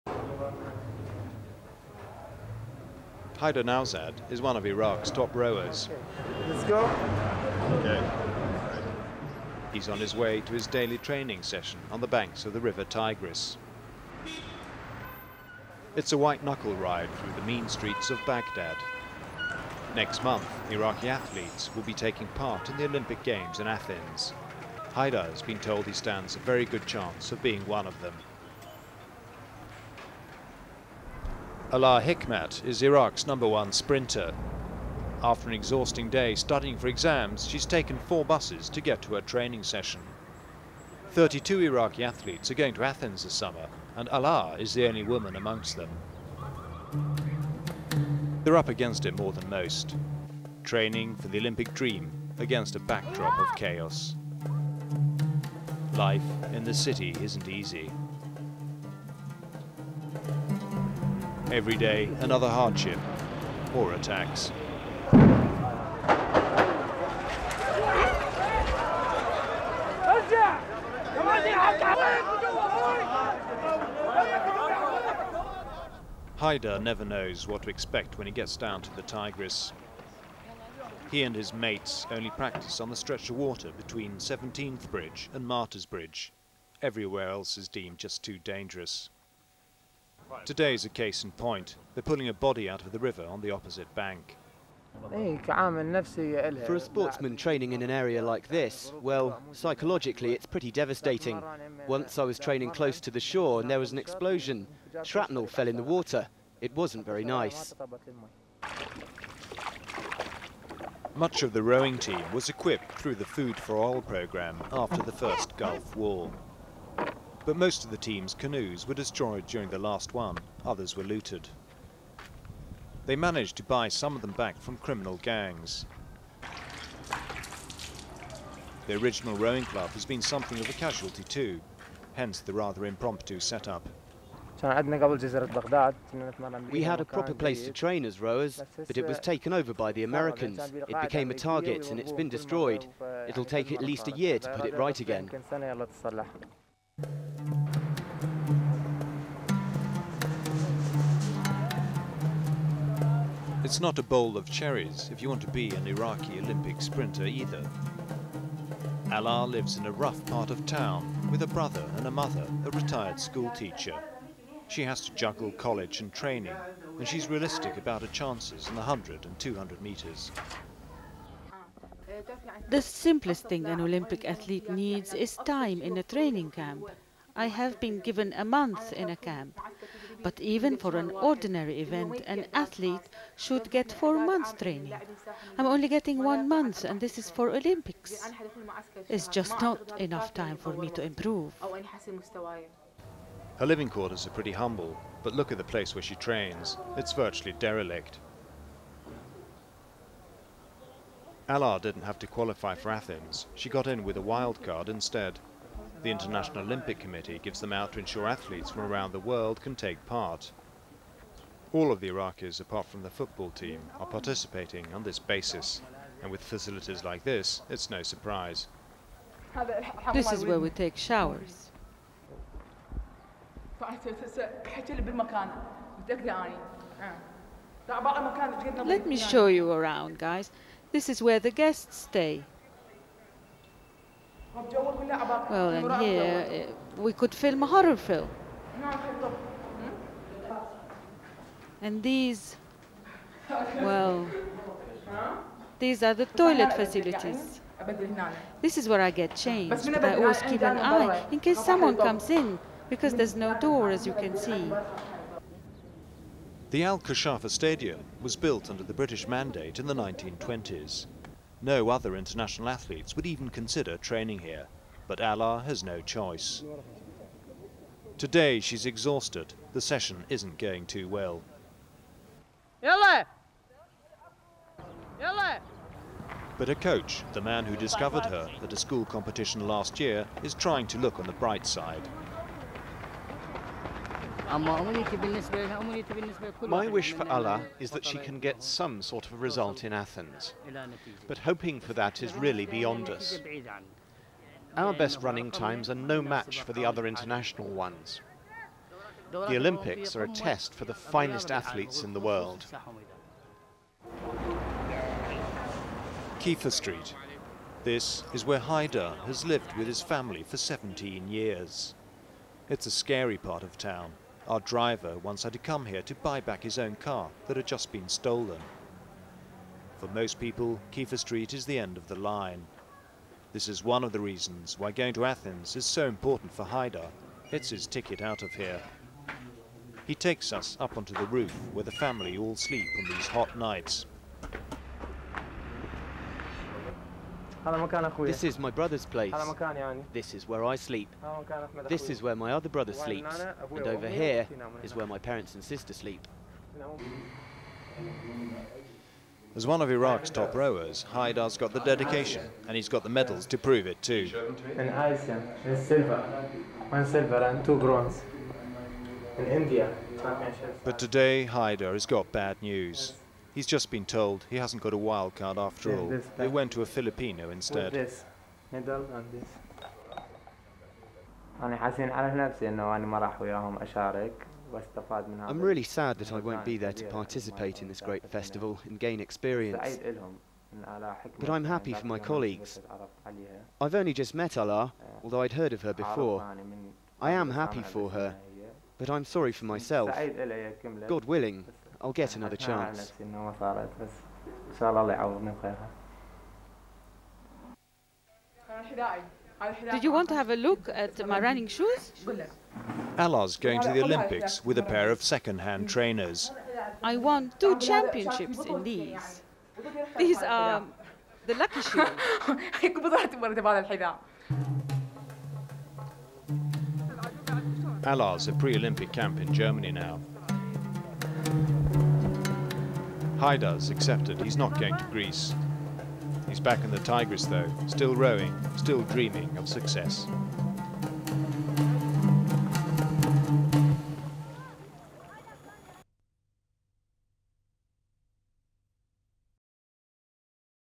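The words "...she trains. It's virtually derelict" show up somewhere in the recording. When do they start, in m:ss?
3:16.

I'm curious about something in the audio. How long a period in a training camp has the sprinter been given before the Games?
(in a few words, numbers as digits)
a month.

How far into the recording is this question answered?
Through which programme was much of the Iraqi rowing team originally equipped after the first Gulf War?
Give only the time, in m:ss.
1:53.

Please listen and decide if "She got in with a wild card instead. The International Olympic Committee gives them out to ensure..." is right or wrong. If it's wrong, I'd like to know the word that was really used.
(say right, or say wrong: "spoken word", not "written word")
right.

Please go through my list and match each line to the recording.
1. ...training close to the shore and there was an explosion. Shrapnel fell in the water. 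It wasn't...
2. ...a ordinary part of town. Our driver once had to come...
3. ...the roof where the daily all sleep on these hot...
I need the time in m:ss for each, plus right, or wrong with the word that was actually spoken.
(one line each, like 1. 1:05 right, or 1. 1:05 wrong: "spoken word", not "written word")
1. 1:42 right
2. 5:12 wrong: "scary", not "ordinary"
3. 5:31 wrong: "family", not "daily".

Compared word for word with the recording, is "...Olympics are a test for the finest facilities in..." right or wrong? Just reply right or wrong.
wrong.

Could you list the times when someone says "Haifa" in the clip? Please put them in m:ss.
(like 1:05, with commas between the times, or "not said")
5:06, 5:20.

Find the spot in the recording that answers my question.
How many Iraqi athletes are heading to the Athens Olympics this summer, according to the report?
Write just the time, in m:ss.
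0:41.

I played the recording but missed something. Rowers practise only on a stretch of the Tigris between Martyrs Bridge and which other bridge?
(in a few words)
17th Bridge.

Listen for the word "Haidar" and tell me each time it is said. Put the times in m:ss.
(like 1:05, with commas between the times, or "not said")
0:03, 0:24, 5:08, 5:26, 5:51, 6:01, 7:03.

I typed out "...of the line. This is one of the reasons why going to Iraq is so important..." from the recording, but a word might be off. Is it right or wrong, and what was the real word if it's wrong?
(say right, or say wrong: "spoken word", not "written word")
wrong: "Athens", not "Iraq".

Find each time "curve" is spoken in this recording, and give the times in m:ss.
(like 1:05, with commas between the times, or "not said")
not said.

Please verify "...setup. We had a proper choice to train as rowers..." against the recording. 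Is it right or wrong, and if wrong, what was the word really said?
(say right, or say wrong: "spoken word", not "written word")
wrong: "place", not "choice".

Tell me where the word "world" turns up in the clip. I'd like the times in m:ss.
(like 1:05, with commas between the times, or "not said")
3:29, 5:02.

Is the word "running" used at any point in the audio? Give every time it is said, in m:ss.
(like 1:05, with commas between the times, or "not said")
4:55, 6:41.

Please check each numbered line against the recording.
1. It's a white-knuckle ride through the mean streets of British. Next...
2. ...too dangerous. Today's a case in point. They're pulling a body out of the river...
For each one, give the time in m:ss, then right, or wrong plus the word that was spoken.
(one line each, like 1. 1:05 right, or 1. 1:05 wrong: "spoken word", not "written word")
1. 0:15 wrong: "Baghdad", not "British"
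2. 1:28 right.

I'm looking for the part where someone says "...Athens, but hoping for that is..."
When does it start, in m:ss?
4:49.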